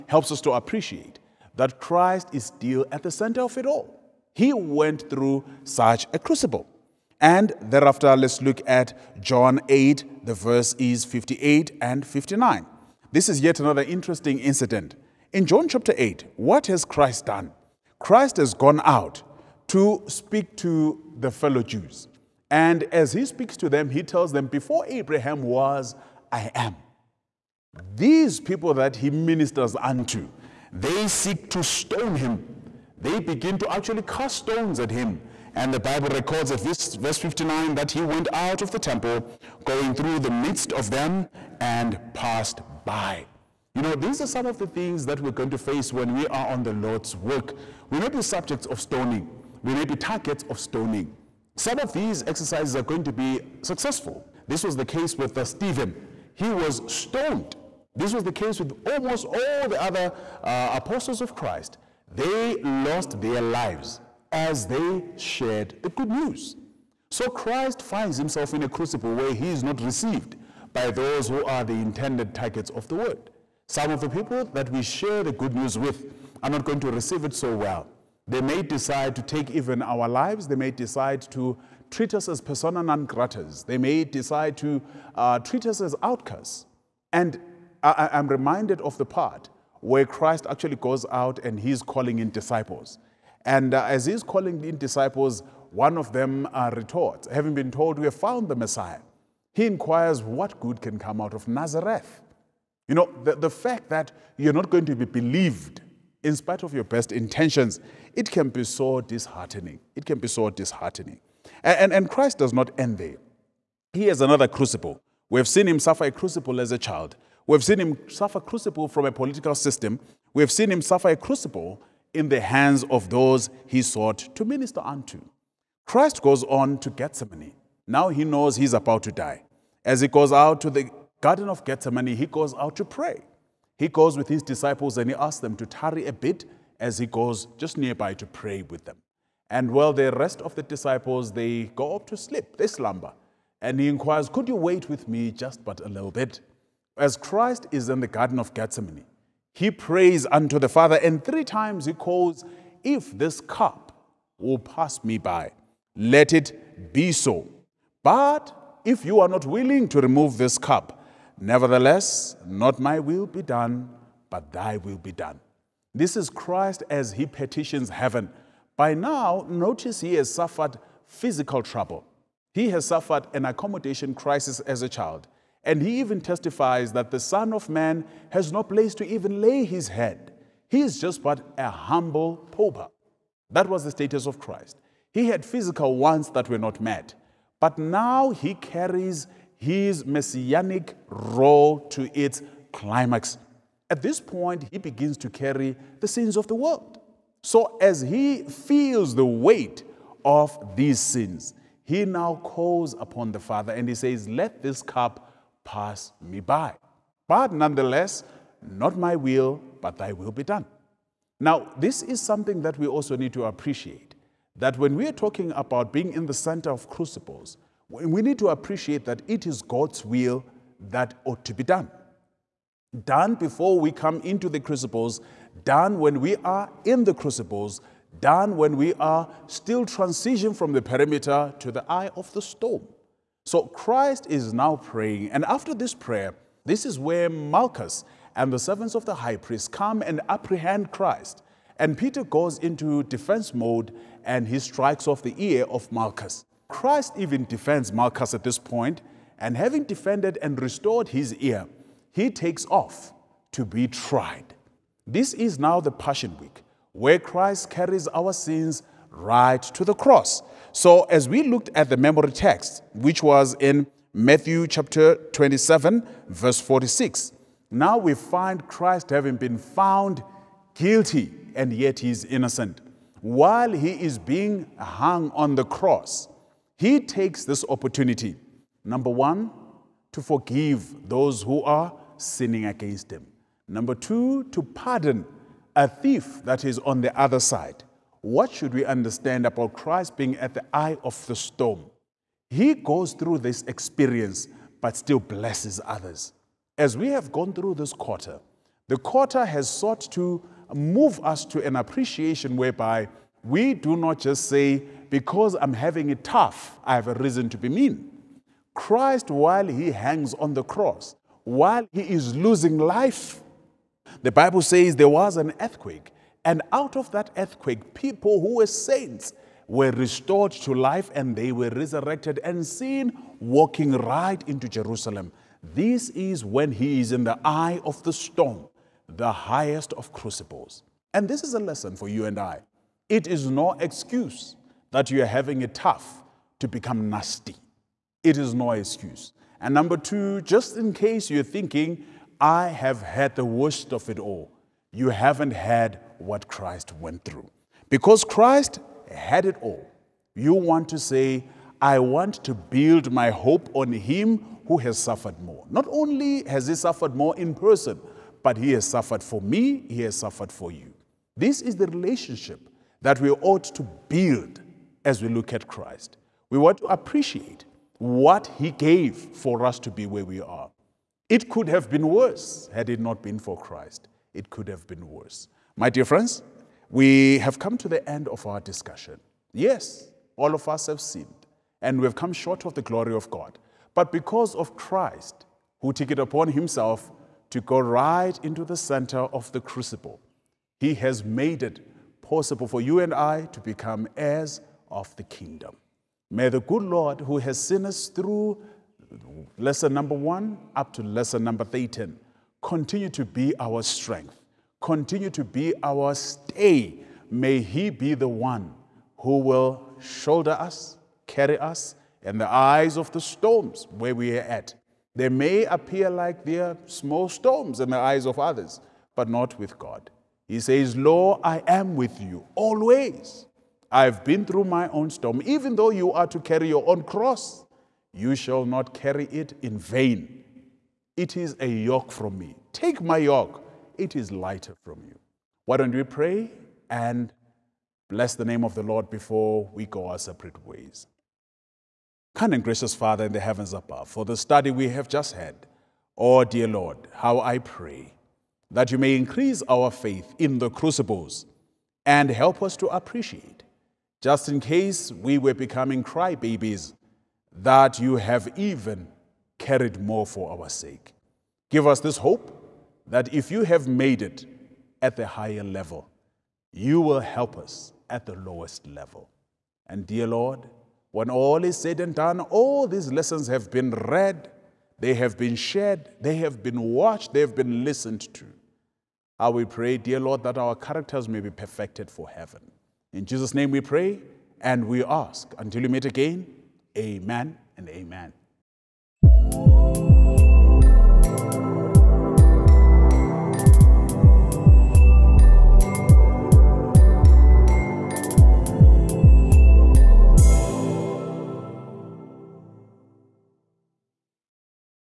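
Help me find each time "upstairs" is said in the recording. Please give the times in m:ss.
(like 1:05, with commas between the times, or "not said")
not said.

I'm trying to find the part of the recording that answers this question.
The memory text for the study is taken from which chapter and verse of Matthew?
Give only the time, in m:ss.
4:24.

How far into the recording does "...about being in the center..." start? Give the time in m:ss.
3:35.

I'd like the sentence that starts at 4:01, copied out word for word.
And Peter goes into defense mode and he strikes off the ear of Malchus.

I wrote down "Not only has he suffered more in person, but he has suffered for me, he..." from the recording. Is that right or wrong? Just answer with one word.
right.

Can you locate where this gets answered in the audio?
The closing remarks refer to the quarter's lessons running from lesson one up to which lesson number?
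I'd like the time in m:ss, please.
6:41.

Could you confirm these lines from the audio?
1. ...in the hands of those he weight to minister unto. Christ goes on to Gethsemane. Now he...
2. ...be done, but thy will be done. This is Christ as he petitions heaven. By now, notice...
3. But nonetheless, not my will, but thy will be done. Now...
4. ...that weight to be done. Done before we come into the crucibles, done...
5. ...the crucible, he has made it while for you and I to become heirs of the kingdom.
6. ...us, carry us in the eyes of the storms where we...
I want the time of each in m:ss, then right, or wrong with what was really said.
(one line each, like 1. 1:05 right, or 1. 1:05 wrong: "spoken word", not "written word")
1. 2:02 wrong: "sought", not "weight"
2. 2:43 right
3. 3:27 right
4. 3:40 wrong: "ought", not "weight"
5. 6:29 wrong: "possible", not "while"
6. 6:50 right.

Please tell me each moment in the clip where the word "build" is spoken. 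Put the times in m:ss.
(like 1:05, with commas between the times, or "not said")
5:52, 6:04.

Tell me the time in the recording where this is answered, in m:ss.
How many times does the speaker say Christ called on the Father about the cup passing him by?
2:31.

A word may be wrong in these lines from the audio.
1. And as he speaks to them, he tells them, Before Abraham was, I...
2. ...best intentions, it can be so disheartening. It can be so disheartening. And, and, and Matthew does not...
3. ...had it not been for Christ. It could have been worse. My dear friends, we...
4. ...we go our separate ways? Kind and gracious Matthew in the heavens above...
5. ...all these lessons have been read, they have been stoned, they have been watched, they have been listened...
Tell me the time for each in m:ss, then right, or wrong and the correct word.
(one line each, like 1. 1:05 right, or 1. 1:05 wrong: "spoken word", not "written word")
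1. 0:22 right
2. 1:46 wrong: "Christ", not "Matthew"
3. 6:12 right
4. 7:19 wrong: "Father", not "Matthew"
5. 7:52 wrong: "shared", not "stoned".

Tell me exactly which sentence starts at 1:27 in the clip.
And I- I'm reminded of the part where Christ actually goes out and he's calling in disciples.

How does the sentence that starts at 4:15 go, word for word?
This is now the Passion Week, where Christ carries our sins right to the cross.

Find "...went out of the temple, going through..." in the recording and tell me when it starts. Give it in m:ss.
0:38.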